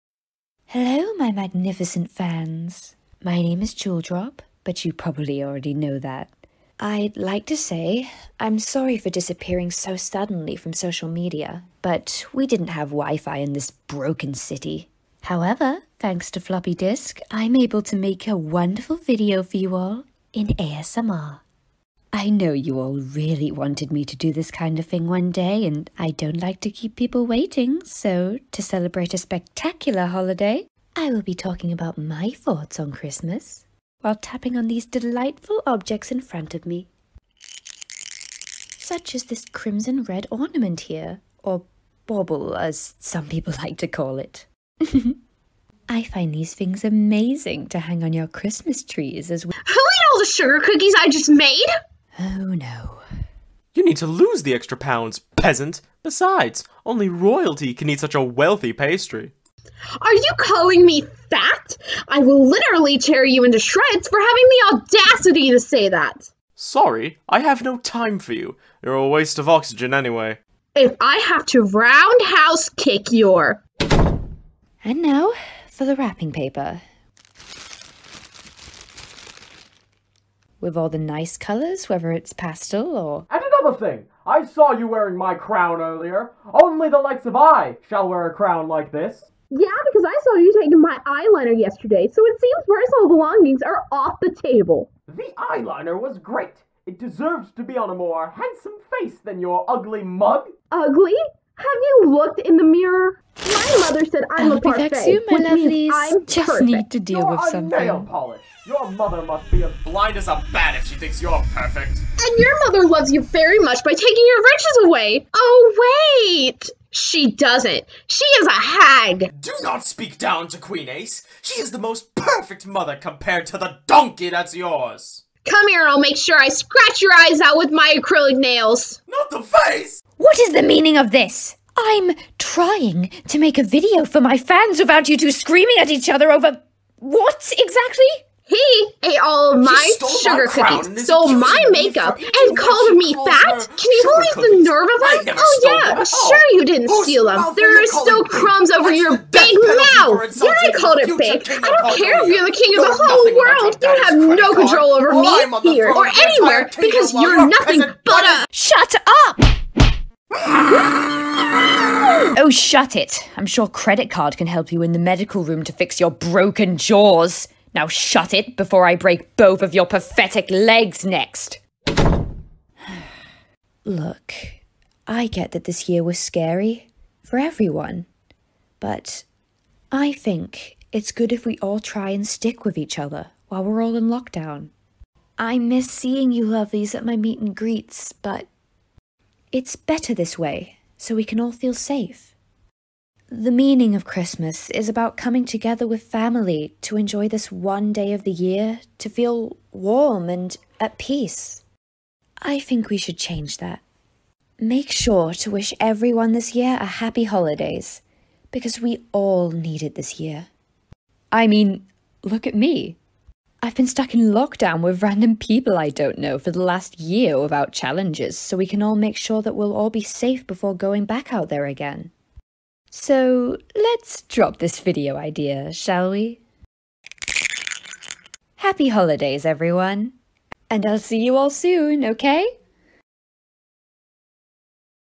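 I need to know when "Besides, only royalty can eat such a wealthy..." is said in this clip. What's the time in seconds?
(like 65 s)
56 s.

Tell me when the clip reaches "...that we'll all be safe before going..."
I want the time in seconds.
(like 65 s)
219 s.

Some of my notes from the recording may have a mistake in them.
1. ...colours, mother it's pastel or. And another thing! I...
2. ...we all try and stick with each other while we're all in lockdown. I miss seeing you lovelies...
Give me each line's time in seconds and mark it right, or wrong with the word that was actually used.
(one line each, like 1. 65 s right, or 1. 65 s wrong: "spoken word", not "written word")
1. 81 s wrong: "whether", not "mother"
2. 181 s right.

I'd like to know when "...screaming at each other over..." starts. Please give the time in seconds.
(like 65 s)
135 s.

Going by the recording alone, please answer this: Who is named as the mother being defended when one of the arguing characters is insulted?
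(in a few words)
Queen Ace.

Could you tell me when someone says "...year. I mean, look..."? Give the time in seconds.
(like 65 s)
210 s.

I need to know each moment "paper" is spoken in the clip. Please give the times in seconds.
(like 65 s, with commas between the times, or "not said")
76 s.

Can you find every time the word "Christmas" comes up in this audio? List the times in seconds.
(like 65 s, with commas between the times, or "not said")
32 s, 48 s, 194 s.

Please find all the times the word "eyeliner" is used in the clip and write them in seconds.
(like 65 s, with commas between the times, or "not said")
91 s, 95 s.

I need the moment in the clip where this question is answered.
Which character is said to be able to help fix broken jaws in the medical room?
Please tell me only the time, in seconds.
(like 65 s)
163 s.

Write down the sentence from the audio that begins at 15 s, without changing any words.
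However, thanks to floppy disk, I'm able to make a wonderful video for you all in ASMR.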